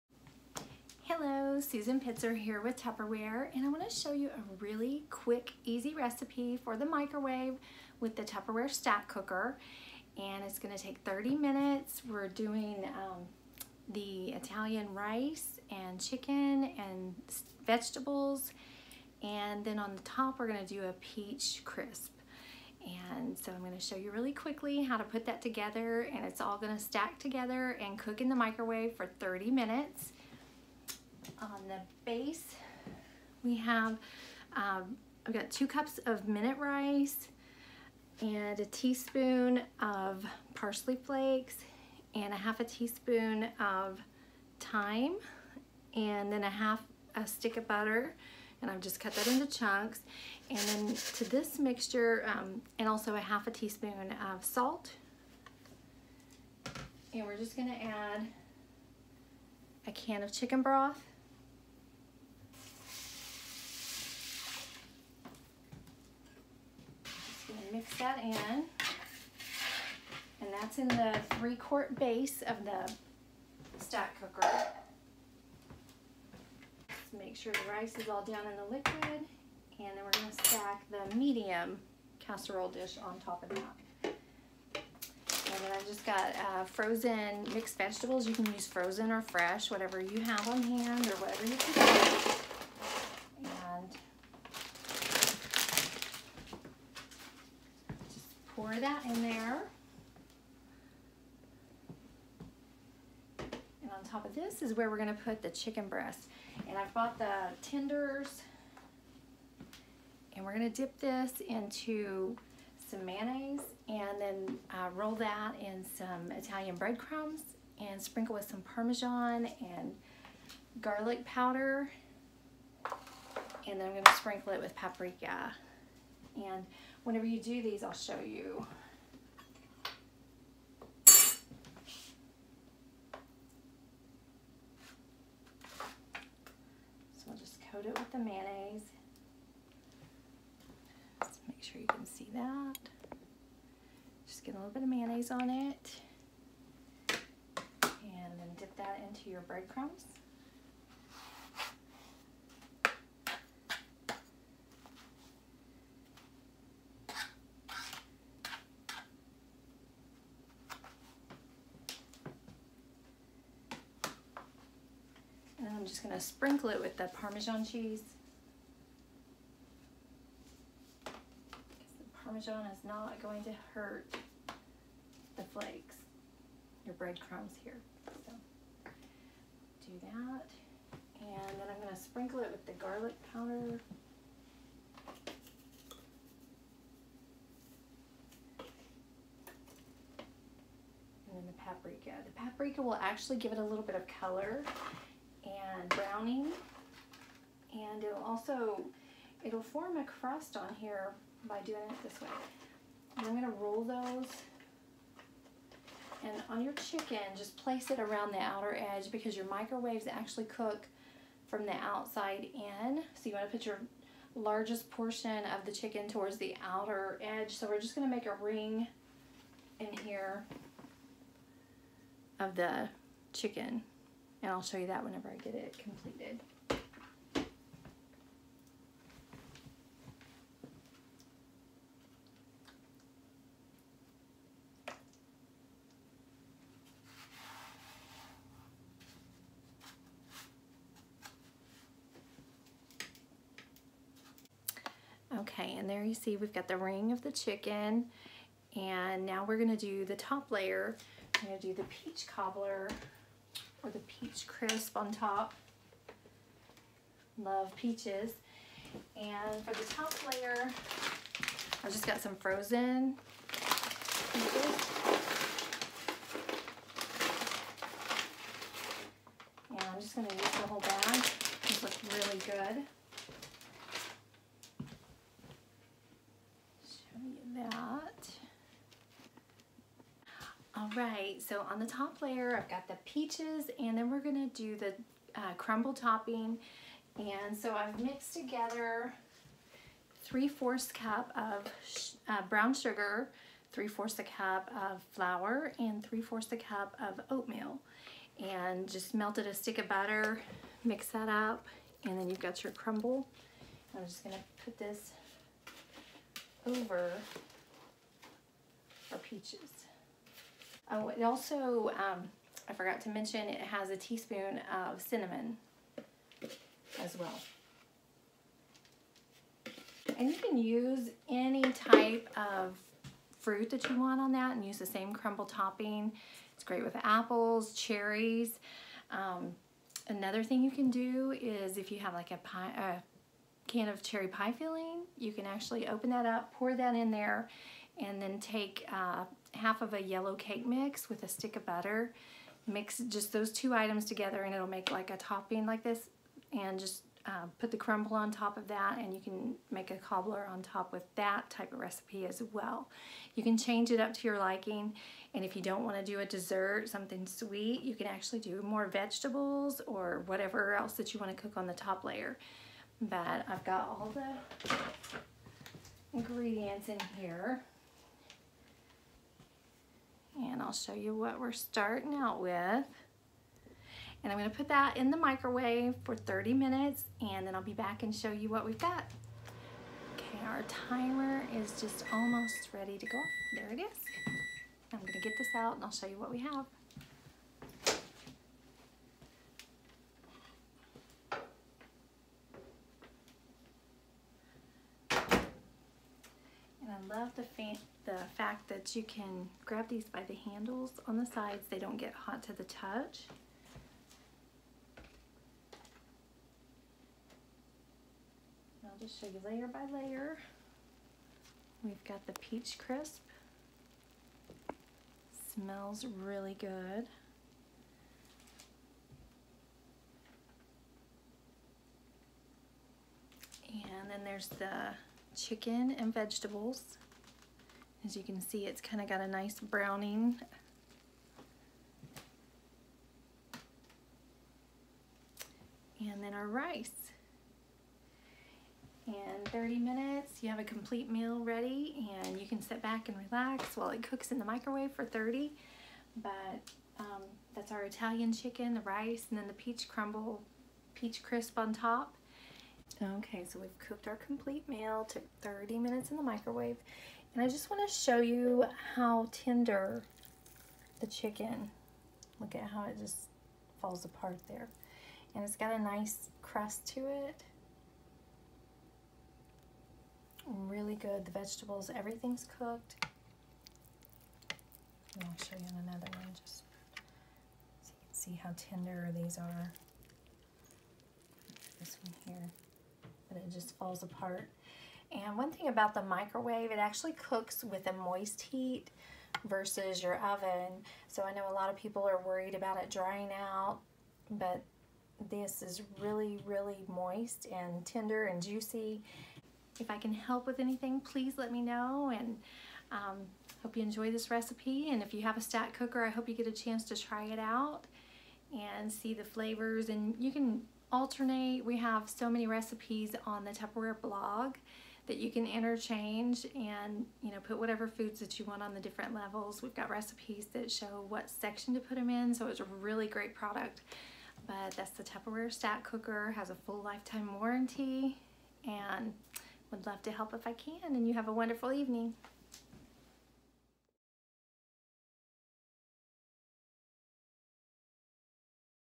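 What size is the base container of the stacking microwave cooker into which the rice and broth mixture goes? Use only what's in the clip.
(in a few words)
3 quart.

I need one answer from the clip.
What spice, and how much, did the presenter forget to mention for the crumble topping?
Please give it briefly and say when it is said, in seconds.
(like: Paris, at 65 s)
1 teaspoon of cinnamon, at 313 s.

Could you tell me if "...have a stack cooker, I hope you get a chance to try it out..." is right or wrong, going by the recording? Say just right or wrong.
right.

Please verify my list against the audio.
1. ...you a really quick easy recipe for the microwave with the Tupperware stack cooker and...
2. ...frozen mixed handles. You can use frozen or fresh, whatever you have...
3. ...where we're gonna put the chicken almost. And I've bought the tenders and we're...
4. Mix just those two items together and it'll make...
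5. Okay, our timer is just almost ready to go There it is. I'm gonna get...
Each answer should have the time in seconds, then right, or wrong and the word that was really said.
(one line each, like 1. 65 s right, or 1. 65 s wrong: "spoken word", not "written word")
1. 4 s right
2. 86 s wrong: "vegetables", not "handles"
3. 104 s wrong: "breast", not "almost"
4. 342 s right
5. 380 s right.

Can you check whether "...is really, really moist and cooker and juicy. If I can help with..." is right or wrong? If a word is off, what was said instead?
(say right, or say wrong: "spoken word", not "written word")
wrong: "tender", not "cooker".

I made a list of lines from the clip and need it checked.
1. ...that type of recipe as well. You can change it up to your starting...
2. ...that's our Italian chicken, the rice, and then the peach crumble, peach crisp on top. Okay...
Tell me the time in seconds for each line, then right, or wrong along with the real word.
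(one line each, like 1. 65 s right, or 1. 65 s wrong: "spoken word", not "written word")
1. 351 s wrong: "liking", not "starting"
2. 447 s right.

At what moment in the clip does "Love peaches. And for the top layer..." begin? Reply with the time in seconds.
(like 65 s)
257 s.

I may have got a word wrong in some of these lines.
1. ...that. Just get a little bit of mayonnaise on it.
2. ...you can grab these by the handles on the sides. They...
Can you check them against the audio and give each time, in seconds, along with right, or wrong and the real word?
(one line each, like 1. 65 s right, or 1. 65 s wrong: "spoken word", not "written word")
1. 142 s right
2. 398 s right.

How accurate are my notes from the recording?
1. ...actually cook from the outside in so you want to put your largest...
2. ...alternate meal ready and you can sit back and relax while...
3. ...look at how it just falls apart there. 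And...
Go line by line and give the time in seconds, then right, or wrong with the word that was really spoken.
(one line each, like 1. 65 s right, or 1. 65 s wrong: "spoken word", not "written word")
1. 210 s right
2. 440 s wrong: "complete", not "alternate"
3. 462 s right.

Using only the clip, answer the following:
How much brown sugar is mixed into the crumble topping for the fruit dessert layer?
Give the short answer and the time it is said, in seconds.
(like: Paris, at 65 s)
3/4 cup, at 290 s.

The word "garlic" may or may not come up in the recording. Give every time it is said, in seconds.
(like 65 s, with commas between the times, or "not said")
120 s, 182 s.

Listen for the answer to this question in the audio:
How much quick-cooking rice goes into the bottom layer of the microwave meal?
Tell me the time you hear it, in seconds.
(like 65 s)
35 s.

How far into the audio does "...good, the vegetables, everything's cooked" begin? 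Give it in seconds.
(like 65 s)
470 s.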